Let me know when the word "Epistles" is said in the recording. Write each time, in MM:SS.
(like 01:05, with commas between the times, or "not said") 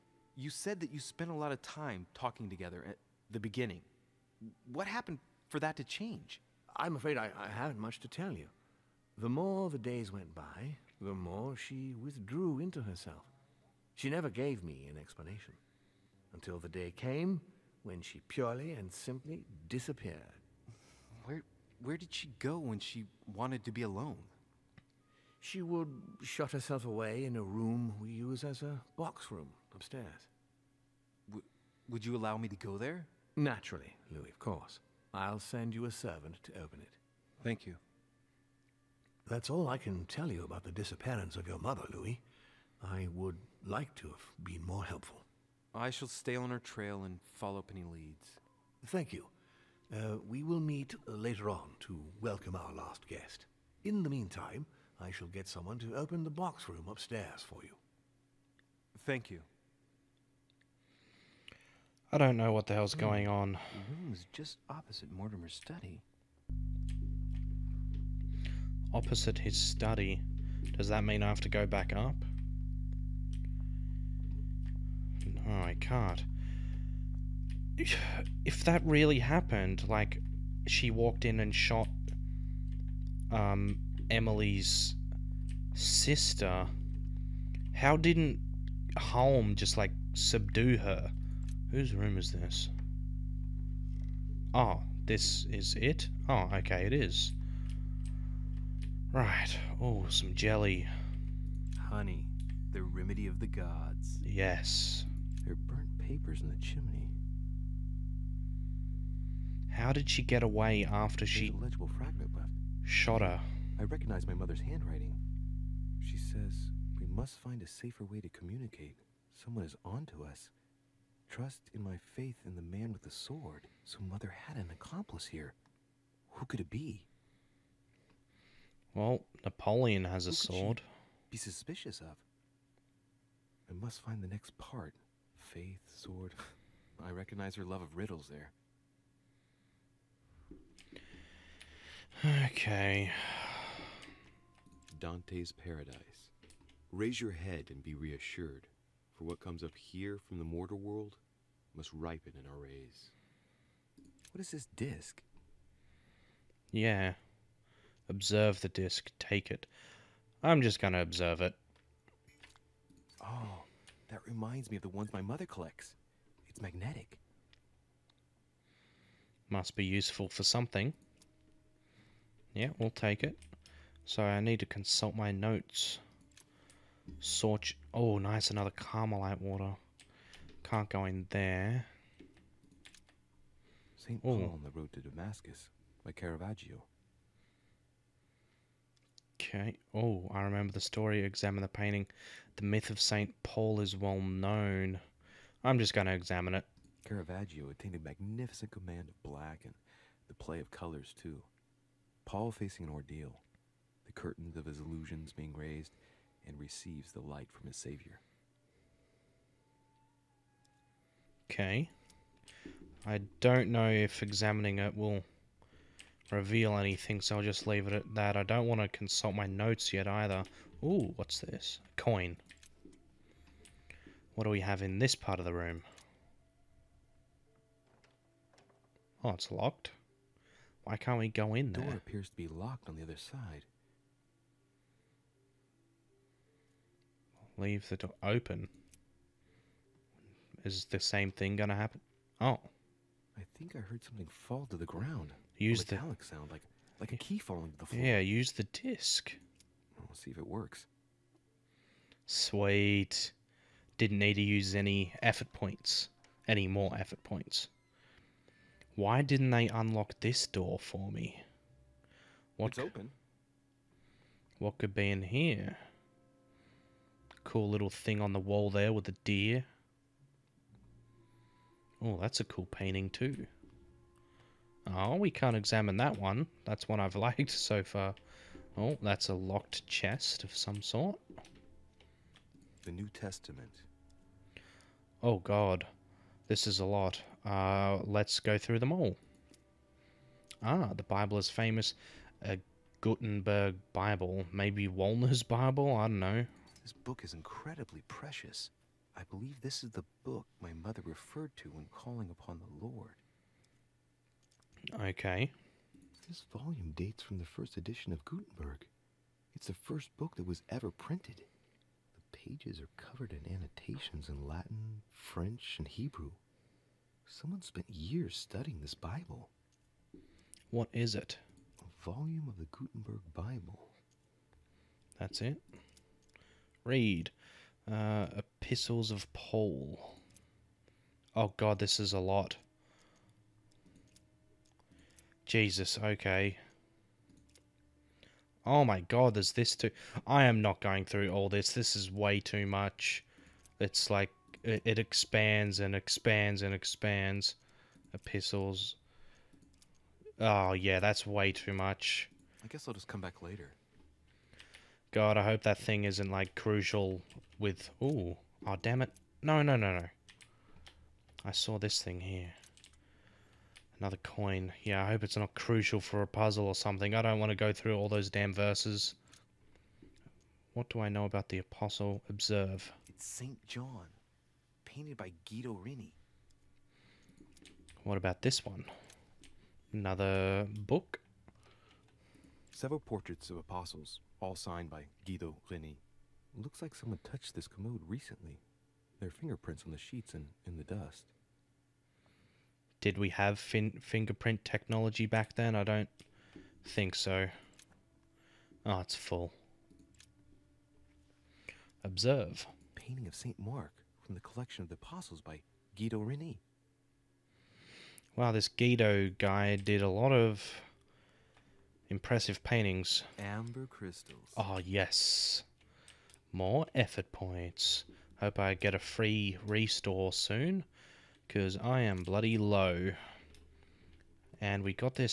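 05:28, 05:48.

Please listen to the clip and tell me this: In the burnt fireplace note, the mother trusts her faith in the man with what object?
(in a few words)
The sword.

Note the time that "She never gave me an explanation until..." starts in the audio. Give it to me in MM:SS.
00:13.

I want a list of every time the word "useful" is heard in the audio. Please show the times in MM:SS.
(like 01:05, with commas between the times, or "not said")
02:49.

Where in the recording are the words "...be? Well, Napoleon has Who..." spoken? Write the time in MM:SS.
02:06.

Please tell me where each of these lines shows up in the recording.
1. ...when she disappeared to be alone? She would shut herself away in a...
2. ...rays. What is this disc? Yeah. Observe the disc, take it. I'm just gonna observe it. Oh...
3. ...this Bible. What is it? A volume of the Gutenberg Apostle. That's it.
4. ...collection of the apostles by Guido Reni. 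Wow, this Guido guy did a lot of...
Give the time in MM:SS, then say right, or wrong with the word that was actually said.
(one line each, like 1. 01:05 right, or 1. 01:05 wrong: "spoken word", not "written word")
1. 00:22 wrong: "wanted", not "disappeared"
2. 02:32 right
3. 05:18 wrong: "Bible", not "Apostle"
4. 06:44 right.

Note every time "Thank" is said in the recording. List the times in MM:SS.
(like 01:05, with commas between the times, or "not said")
00:37, 00:48, 00:59.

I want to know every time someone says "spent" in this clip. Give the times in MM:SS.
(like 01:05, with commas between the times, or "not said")
00:00, 05:17.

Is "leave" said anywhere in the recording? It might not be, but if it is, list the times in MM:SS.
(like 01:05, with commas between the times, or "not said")
03:37, 03:57.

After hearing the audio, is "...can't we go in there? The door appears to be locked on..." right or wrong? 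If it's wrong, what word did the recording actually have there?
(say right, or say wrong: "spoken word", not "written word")
right.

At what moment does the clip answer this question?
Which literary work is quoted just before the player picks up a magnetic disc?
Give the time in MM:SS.
02:24.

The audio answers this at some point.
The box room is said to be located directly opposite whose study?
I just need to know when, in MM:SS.
01:05.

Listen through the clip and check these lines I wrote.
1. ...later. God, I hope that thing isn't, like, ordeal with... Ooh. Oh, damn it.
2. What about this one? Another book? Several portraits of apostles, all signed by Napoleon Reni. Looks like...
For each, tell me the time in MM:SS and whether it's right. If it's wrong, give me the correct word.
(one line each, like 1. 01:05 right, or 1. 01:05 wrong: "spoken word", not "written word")
1. 05:53 wrong: "crucial", not "ordeal"
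2. 06:18 wrong: "Guido", not "Napoleon".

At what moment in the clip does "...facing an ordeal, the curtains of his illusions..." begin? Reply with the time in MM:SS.
03:22.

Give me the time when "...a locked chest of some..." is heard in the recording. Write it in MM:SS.
04:39.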